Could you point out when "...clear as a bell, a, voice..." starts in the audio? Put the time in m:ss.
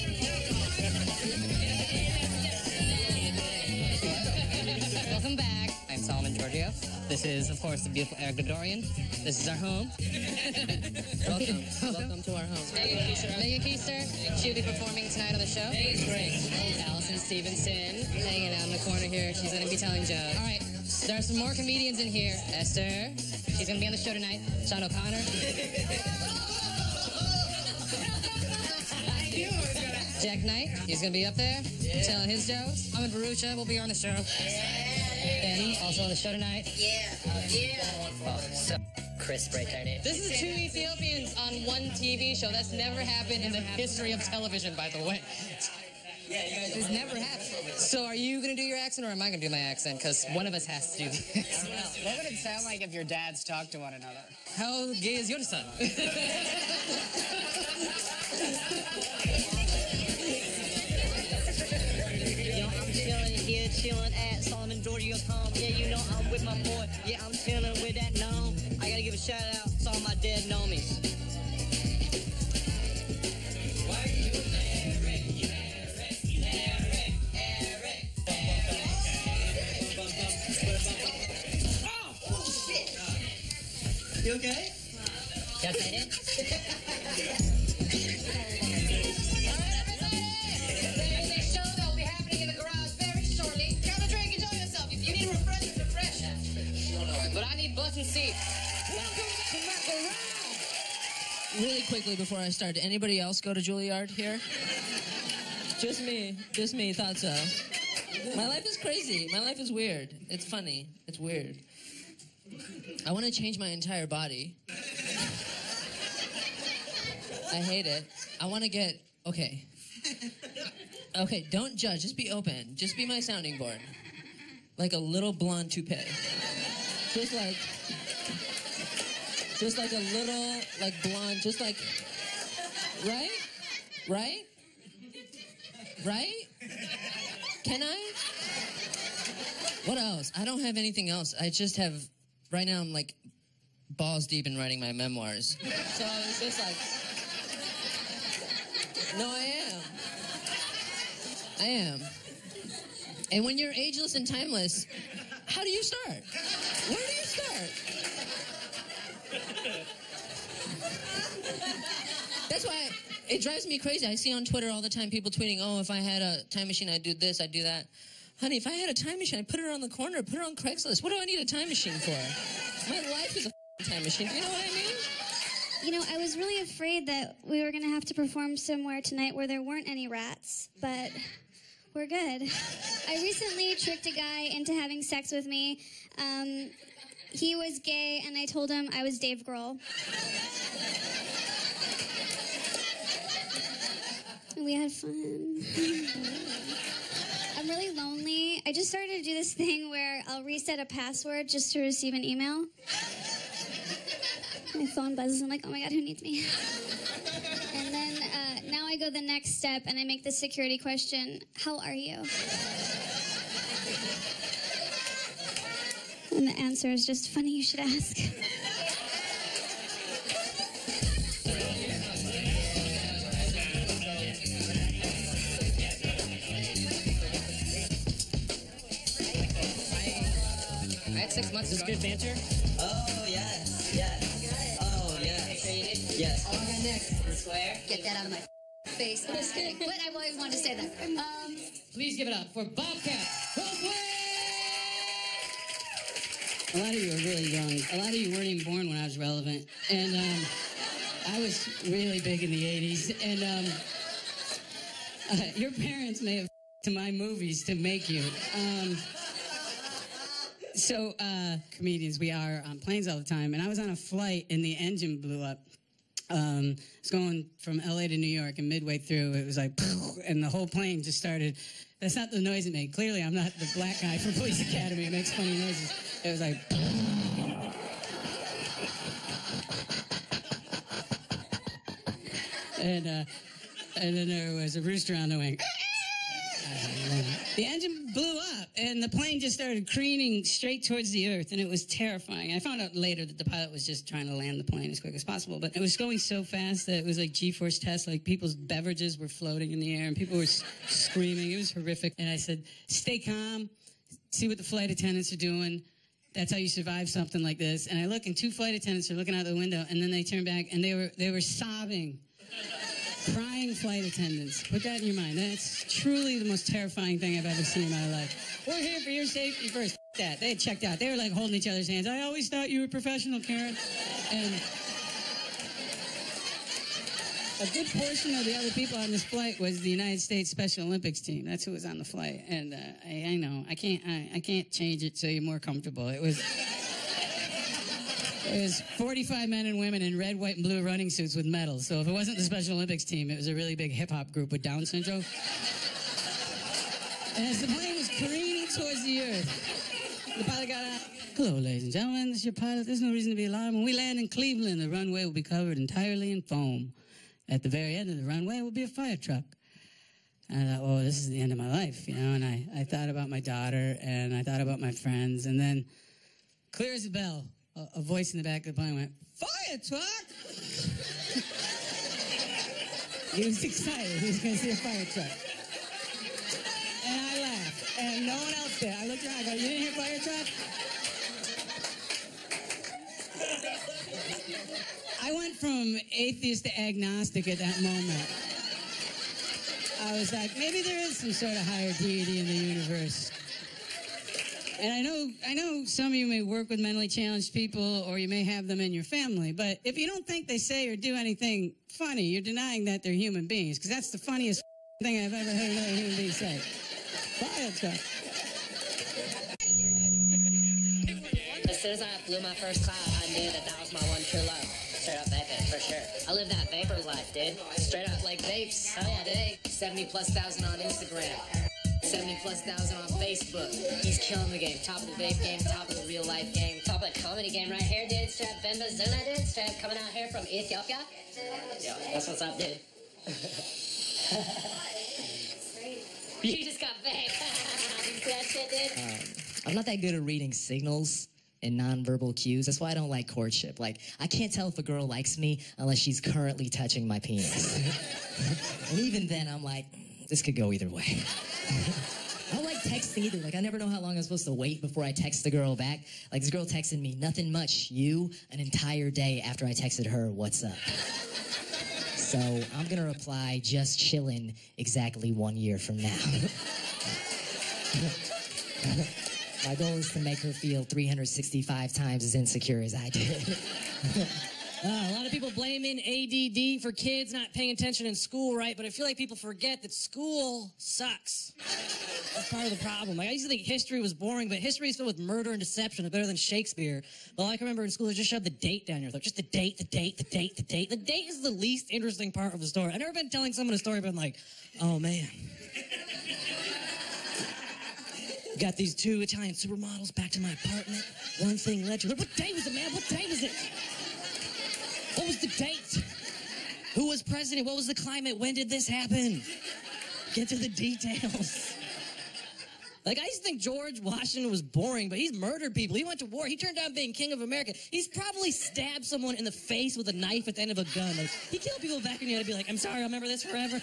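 6:06.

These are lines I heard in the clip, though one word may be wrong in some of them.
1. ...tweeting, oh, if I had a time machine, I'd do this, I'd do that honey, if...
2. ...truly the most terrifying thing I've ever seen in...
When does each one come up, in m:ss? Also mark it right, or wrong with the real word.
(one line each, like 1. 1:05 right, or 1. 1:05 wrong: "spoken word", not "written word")
1. 2:45 right
2. 5:15 right.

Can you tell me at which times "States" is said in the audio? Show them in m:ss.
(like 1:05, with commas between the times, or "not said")
5:30.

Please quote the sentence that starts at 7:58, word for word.
But I feel like people forget that school sucks.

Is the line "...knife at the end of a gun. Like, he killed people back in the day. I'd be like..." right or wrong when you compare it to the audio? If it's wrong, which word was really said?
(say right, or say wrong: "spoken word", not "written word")
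right.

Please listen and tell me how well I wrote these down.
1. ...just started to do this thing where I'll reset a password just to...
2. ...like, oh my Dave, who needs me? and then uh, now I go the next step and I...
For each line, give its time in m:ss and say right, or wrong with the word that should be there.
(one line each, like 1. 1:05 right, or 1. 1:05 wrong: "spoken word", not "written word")
1. 3:18 right
2. 3:25 wrong: "God", not "Dave".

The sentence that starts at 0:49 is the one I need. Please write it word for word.
Because one of us has to do this.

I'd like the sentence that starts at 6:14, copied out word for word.
He was going to see a fire truck.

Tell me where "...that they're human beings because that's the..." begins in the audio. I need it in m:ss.
6:42.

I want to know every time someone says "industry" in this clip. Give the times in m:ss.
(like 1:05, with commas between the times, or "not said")
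not said.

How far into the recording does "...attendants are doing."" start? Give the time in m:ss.
5:04.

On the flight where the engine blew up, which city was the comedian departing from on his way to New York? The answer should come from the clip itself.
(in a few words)
LA.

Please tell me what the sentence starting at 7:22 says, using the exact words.
That's why I don't like courtship.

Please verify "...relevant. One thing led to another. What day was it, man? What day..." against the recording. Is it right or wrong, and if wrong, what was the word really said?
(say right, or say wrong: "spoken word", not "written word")
wrong: "apartment", not "relevant".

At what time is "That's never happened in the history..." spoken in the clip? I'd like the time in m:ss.
0:42.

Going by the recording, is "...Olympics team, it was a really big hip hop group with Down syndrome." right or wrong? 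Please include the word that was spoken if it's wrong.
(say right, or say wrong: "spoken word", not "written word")
right.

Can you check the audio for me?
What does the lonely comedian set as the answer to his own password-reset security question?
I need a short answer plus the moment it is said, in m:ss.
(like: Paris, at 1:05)
funny you should ask, at 3:37.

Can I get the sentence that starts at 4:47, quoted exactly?
the engine and the plane just started careening straight towards the earth, and it was terrifying.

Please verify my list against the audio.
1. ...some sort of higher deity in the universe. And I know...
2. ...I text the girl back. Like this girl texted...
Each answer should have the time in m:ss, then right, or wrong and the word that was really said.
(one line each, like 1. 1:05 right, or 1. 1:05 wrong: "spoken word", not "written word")
1. 6:31 right
2. 7:35 right.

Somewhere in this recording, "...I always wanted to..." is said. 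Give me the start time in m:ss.
3:59.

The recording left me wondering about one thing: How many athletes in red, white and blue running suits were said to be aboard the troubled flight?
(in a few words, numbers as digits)
45.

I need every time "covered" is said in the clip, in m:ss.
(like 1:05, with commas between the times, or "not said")
5:55.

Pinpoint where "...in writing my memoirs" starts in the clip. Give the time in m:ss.
2:24.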